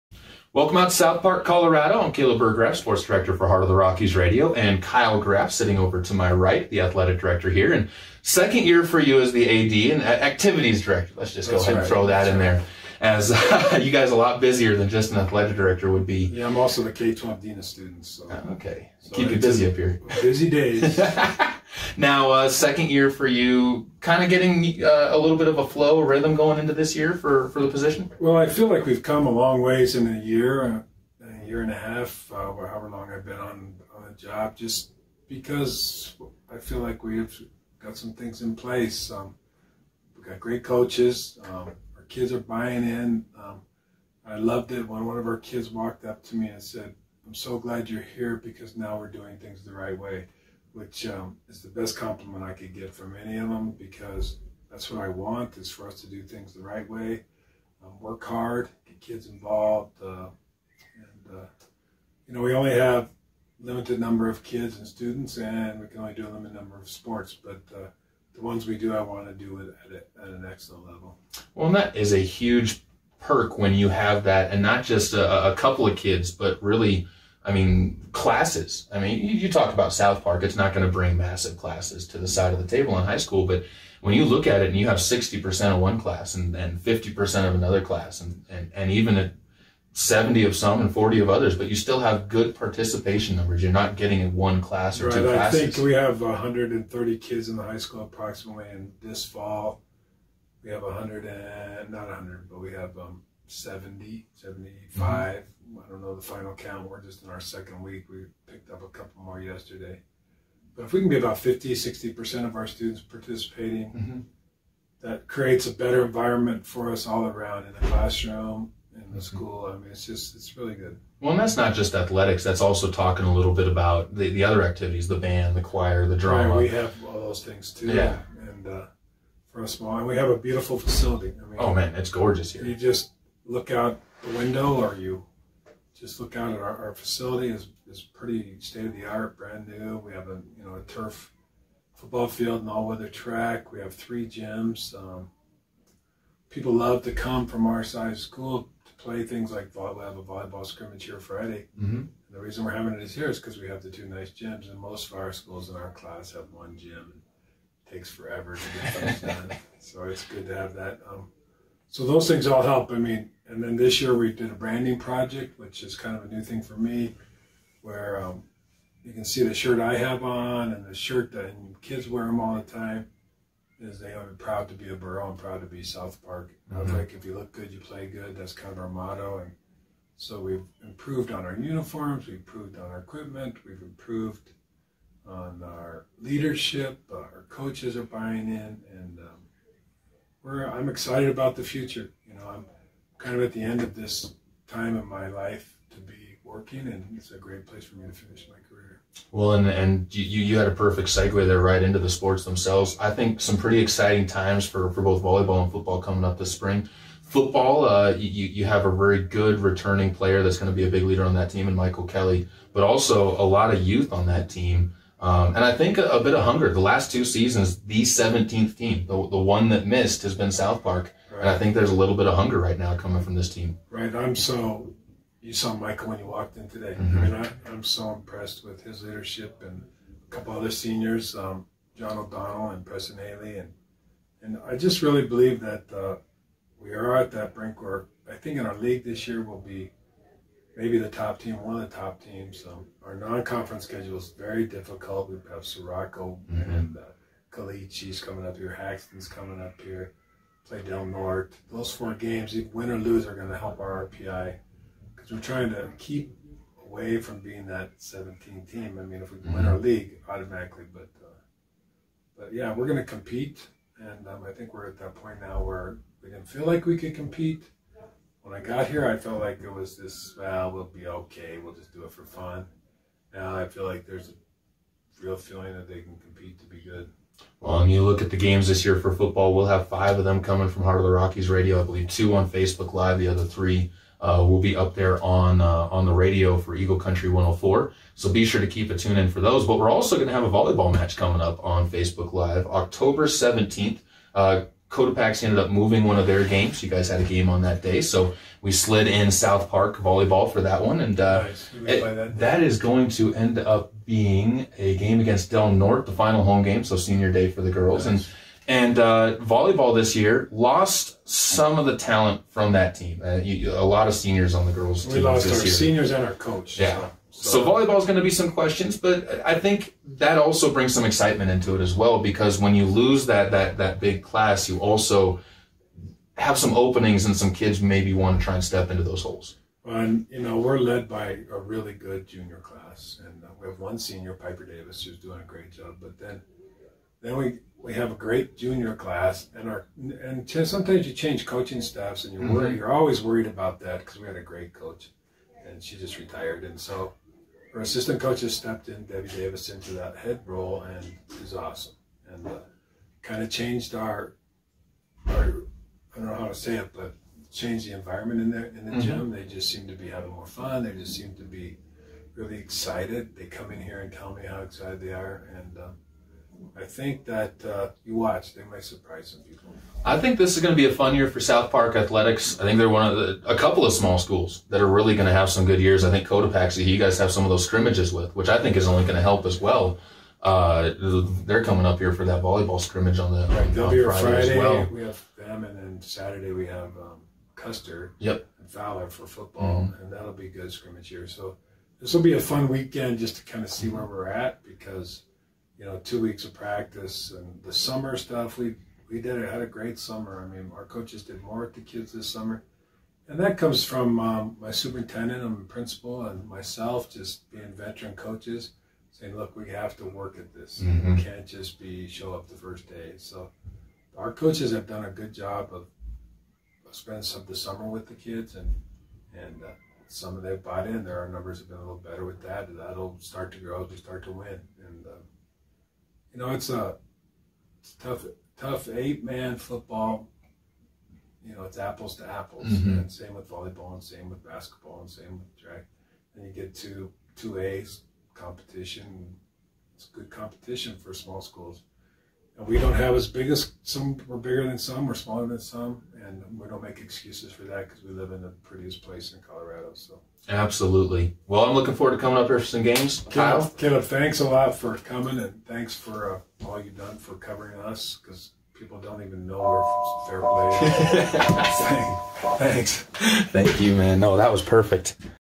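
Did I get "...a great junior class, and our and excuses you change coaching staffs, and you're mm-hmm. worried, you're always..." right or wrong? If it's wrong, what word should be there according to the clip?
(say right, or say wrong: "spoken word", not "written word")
wrong: "sometimes", not "excuses".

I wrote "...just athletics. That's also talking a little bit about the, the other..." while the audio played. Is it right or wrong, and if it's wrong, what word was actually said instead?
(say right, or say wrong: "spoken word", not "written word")
right.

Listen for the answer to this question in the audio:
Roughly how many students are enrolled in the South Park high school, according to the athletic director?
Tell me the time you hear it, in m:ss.
1:36.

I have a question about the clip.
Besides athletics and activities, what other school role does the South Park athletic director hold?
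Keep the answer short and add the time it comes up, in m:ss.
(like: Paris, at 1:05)
K-12 dean of students, at 0:16.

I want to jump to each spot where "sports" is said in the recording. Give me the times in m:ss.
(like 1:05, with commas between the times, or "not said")
0:02, 1:06, 3:22.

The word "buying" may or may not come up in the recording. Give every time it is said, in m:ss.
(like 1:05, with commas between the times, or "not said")
0:42, 3:08.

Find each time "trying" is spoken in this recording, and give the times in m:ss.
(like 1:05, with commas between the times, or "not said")
4:15.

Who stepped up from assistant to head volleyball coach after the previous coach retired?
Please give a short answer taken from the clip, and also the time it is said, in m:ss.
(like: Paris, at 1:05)
Debbie Davis, at 5:49.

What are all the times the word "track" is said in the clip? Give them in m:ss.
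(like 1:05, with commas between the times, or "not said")
2:23, 7:15.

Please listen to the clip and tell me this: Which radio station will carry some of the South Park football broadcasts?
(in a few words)
Eagle Country 104.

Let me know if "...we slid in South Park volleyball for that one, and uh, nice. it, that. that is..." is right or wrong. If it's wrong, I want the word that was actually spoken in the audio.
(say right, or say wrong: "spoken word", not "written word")
right.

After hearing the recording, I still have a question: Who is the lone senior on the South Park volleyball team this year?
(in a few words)
Piper Davis.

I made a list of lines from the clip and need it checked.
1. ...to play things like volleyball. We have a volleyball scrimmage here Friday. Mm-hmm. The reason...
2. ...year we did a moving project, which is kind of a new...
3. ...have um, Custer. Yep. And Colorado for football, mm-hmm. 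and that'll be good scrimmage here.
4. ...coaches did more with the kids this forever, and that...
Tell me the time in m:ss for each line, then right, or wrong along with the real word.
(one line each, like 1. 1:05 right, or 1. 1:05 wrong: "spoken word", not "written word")
1. 2:28 right
2. 2:44 wrong: "branding", not "moving"
3. 6:26 wrong: "Fowler", not "Colorado"
4. 6:40 wrong: "summer", not "forever".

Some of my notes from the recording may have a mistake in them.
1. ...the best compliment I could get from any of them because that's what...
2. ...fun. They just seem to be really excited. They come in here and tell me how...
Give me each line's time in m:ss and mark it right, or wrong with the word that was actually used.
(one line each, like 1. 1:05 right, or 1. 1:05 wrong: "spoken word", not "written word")
1. 0:51 right
2. 6:00 right.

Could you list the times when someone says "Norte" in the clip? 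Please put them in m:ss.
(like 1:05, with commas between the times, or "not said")
4:11, 5:05.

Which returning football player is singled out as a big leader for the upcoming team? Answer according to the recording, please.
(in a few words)
Michael Kelly.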